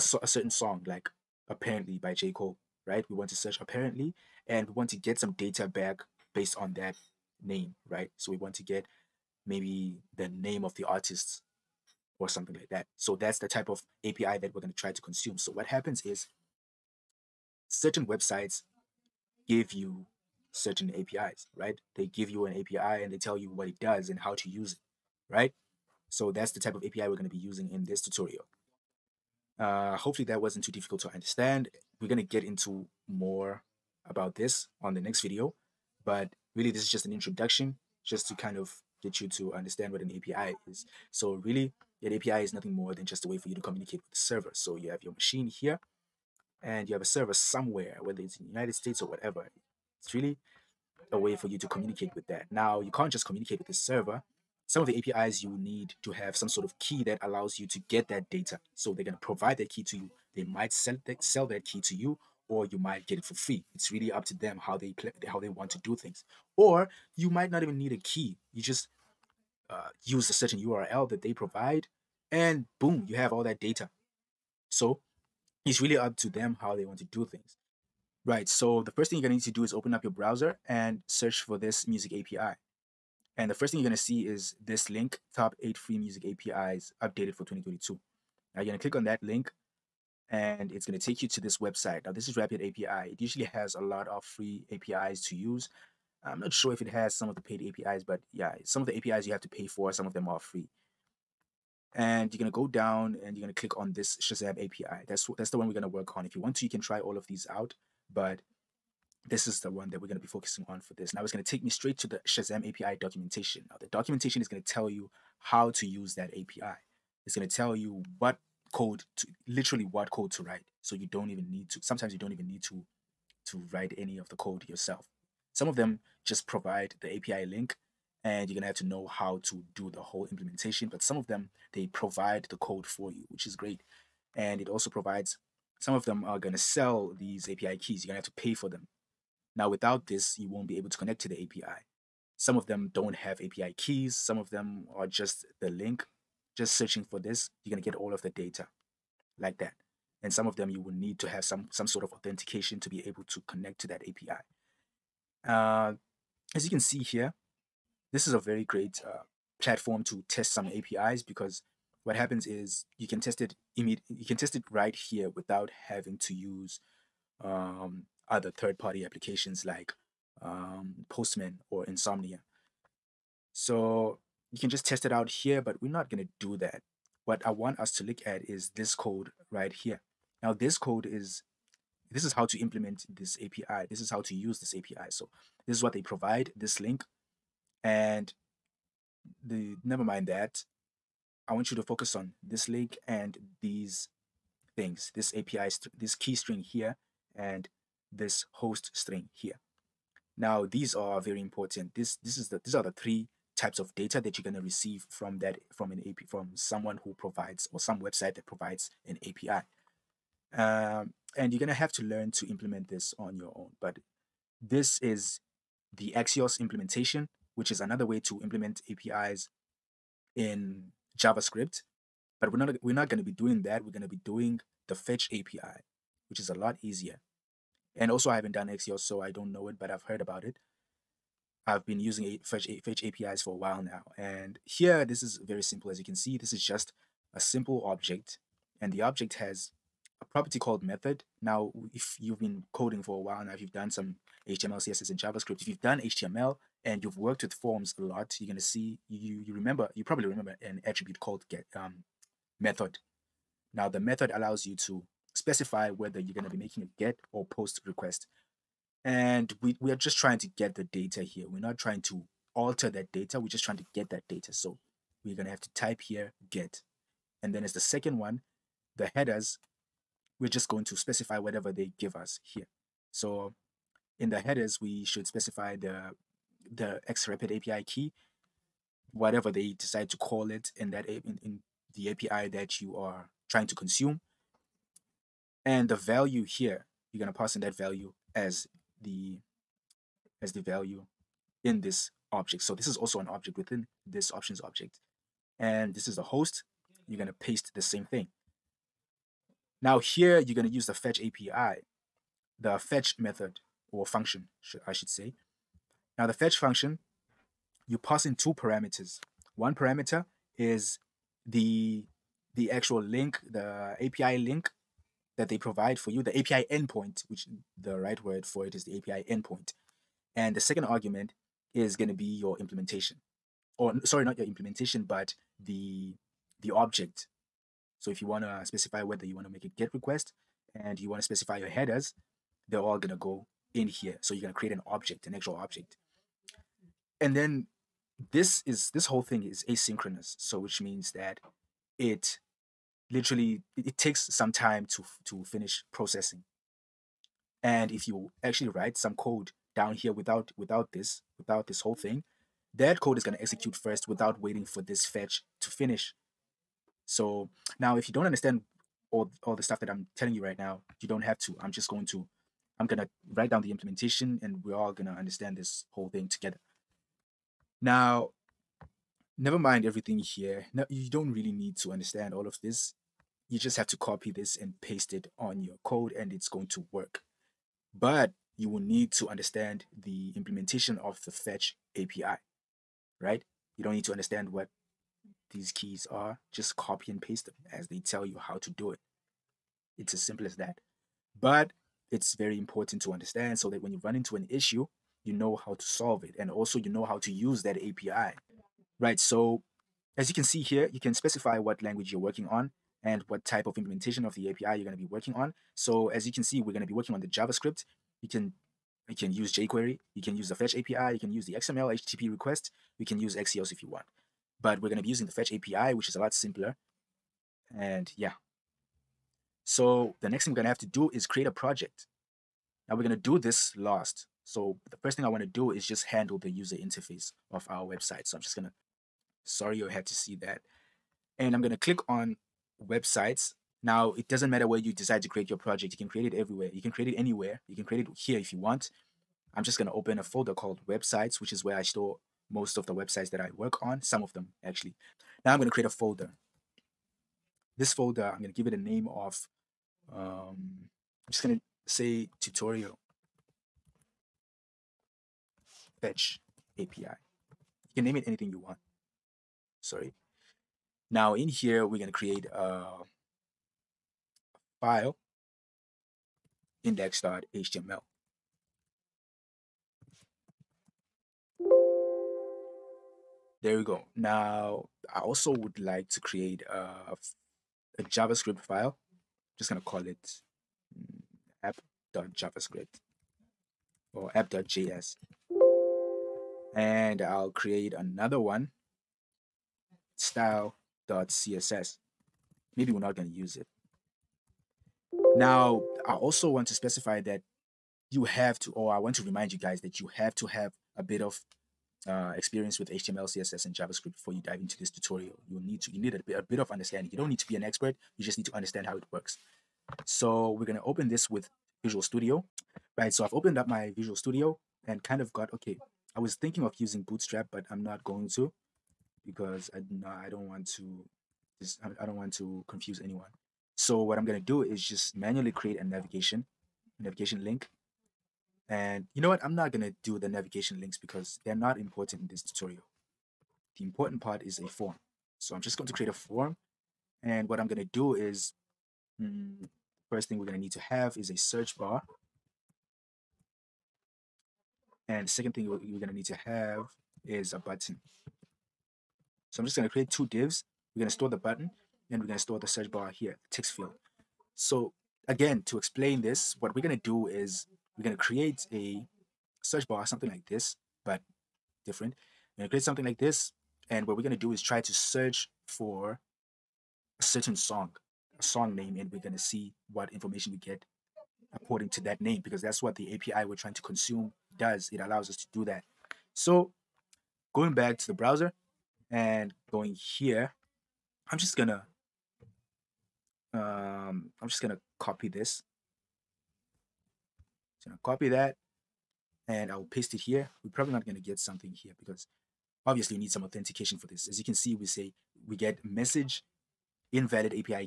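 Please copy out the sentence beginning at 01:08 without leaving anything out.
You just uh, use a certain URL that they provide, and boom, you have all that data.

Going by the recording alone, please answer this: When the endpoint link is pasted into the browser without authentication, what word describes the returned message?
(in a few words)
invalid.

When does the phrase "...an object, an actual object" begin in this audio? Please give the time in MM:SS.
05:34.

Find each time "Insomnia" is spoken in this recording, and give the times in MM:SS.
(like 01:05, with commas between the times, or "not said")
02:51.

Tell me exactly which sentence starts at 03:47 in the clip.
And also, I haven't done Axios, so I don't know it, but I've heard about it.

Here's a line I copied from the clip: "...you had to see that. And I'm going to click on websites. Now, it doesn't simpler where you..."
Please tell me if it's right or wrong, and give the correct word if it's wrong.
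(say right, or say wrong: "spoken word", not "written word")
wrong: "matter", not "simpler".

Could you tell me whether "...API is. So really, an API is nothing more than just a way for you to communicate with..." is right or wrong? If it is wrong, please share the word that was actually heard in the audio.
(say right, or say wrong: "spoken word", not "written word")
right.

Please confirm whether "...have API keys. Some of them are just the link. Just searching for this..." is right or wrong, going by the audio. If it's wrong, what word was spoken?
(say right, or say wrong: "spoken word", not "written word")
right.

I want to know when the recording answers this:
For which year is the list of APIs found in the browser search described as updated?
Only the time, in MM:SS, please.
01:27.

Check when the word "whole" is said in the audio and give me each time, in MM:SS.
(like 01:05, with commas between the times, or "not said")
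02:10, 05:39, 05:51, 06:05.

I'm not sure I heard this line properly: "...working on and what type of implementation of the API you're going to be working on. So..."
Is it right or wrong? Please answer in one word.
right.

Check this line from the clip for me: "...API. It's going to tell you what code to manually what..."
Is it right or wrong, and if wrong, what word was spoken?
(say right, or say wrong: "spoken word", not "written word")
wrong: "literally", not "manually".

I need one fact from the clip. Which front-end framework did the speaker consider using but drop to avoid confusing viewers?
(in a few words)
Bootstrap.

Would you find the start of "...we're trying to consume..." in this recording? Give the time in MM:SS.
09:33.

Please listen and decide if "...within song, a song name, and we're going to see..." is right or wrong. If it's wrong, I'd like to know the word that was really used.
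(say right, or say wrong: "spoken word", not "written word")
wrong: "certain", not "within".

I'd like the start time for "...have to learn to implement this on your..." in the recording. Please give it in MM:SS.
03:31.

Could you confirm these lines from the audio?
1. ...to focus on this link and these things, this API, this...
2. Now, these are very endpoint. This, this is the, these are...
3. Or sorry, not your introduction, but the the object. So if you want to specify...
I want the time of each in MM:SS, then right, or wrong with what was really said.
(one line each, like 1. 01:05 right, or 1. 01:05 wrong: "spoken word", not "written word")
1. 03:11 right
2. 03:20 wrong: "important", not "endpoint"
3. 05:23 wrong: "implementation", not "introduction".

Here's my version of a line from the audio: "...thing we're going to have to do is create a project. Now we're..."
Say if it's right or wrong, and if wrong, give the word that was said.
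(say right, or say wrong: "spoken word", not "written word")
right.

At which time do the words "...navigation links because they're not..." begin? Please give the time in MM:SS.
08:50.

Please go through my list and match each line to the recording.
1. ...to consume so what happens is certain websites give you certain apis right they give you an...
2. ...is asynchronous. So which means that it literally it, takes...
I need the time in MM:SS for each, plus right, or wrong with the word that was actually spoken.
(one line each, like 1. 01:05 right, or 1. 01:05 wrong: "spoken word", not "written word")
1. 00:14 right
2. 05:39 right.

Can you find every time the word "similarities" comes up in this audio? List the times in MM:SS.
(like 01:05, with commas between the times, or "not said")
not said.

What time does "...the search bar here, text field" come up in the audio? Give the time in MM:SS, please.
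09:12.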